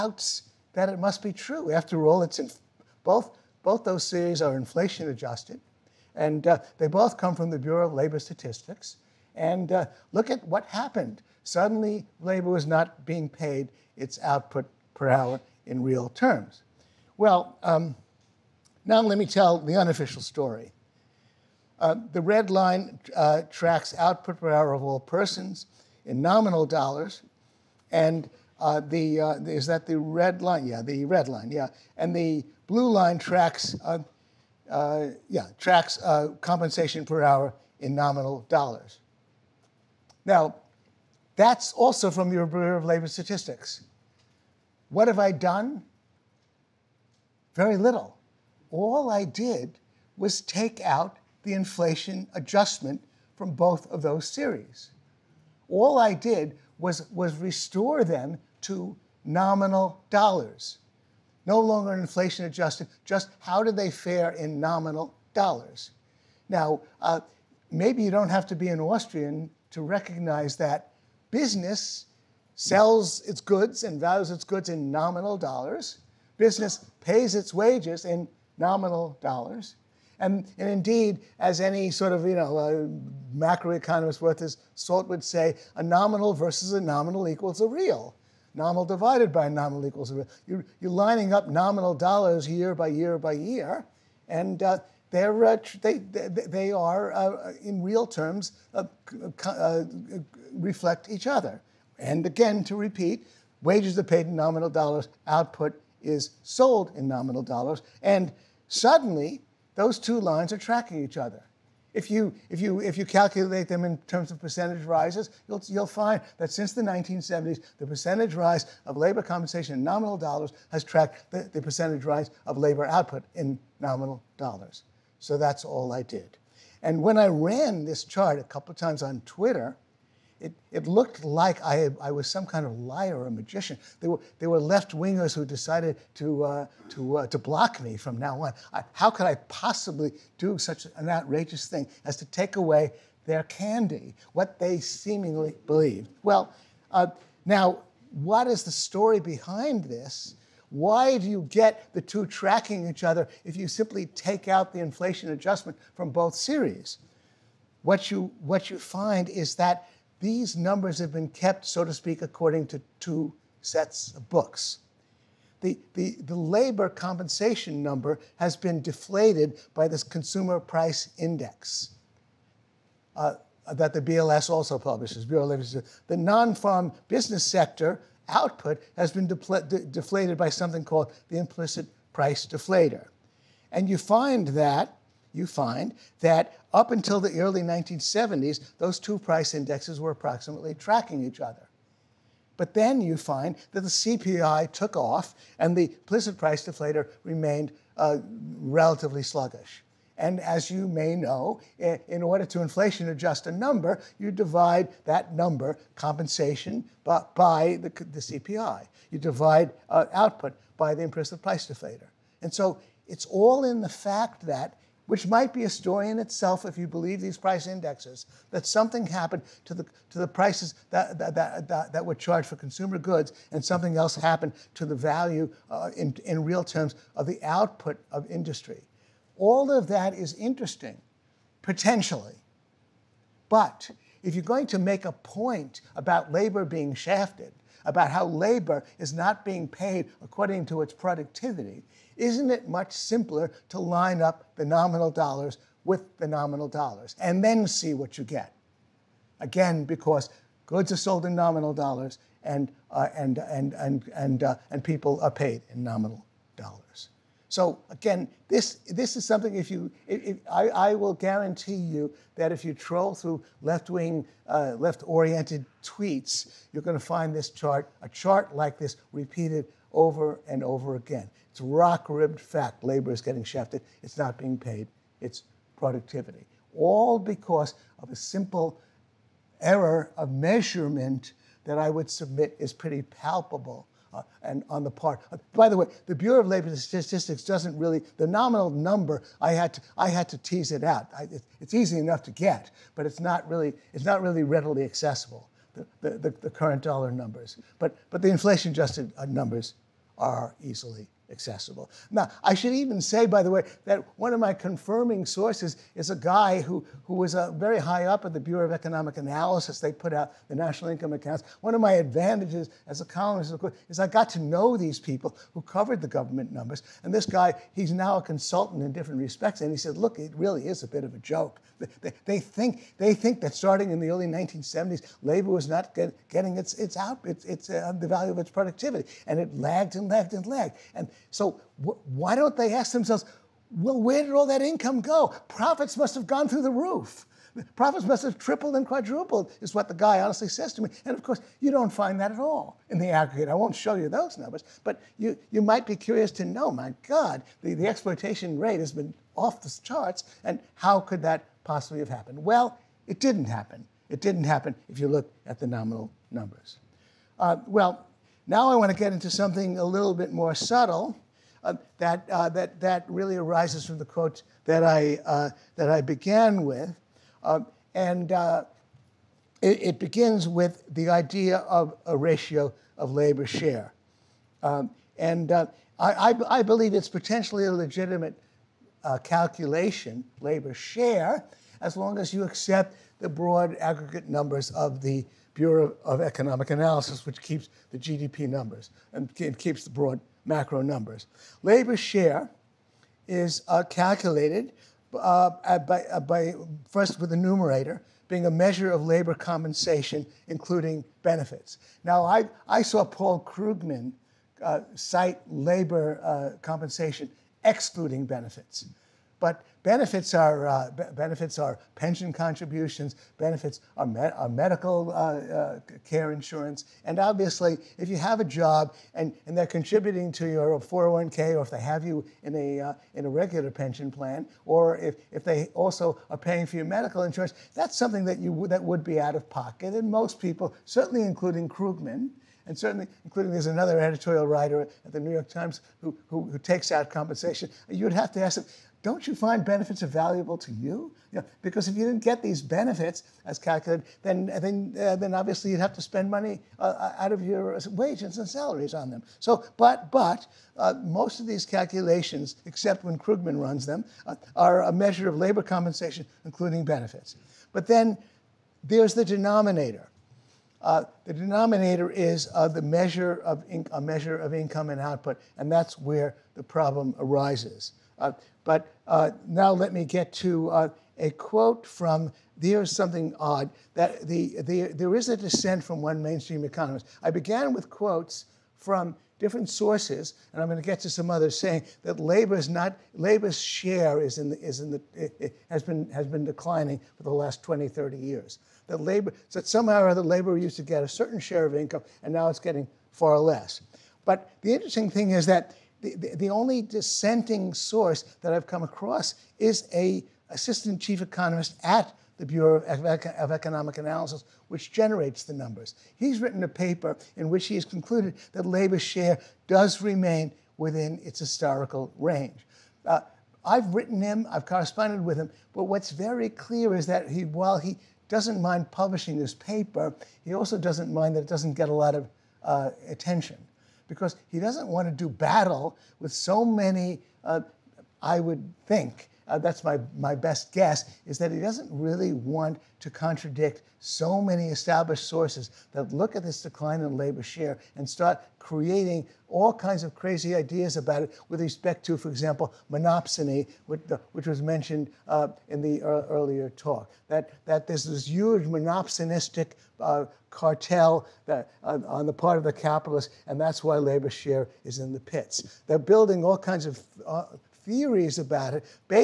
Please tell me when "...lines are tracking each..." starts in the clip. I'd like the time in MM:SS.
01:50.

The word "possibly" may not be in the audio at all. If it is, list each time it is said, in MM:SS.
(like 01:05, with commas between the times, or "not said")
02:19, 05:51.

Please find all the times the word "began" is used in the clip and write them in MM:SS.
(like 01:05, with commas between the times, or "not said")
06:06, 07:57.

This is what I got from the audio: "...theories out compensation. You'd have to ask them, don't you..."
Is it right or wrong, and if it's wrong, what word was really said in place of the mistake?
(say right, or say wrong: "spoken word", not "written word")
wrong: "takes", not "theories".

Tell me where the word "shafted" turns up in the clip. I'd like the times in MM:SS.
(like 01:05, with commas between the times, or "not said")
03:56, 04:33.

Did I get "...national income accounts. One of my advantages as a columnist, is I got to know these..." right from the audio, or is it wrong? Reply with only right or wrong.
right.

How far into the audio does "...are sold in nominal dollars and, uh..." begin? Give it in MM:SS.
04:10.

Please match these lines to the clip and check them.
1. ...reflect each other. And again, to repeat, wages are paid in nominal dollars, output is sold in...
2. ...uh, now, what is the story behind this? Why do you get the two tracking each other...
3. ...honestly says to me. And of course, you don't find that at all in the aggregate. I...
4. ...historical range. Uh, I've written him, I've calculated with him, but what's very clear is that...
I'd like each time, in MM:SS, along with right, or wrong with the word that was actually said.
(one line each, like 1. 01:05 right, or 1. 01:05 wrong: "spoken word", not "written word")
1. 01:40 right
2. 02:26 right
3. 05:40 right
4. 08:31 wrong: "corresponded", not "calculated".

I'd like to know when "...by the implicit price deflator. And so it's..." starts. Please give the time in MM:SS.
03:30.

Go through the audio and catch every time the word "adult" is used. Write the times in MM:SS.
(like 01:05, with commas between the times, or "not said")
not said.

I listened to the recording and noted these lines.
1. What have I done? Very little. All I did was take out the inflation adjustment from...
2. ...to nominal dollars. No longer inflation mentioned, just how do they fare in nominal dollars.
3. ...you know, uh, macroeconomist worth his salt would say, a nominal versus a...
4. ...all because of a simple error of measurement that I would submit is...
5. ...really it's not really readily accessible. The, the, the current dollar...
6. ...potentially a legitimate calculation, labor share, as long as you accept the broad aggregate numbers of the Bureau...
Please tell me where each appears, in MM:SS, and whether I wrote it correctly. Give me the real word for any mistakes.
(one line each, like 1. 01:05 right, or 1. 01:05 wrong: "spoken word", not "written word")
1. 00:44 right
2. 00:58 wrong: "adjusted", not "mentioned"
3. 01:22 right
4. 04:36 right
5. 04:53 right
6. 06:17 right.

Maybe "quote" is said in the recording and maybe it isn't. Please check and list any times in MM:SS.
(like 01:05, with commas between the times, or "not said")
06:04, 07:51, 07:57.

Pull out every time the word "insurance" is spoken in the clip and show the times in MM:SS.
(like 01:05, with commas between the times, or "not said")
06:56, 07:07.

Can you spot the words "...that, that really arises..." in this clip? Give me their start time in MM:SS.
06:02.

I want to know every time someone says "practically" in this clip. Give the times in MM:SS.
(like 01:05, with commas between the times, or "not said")
not said.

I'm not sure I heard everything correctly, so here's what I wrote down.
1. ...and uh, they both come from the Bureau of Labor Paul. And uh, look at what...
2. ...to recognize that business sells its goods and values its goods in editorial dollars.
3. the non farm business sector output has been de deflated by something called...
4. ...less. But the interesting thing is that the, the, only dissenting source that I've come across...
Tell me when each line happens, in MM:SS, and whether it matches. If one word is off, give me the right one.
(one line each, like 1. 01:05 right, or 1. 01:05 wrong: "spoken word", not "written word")
1. 00:06 wrong: "Statistics", not "Paul"
2. 01:09 wrong: "nominal", not "editorial"
3. 02:56 right
4. 08:13 right.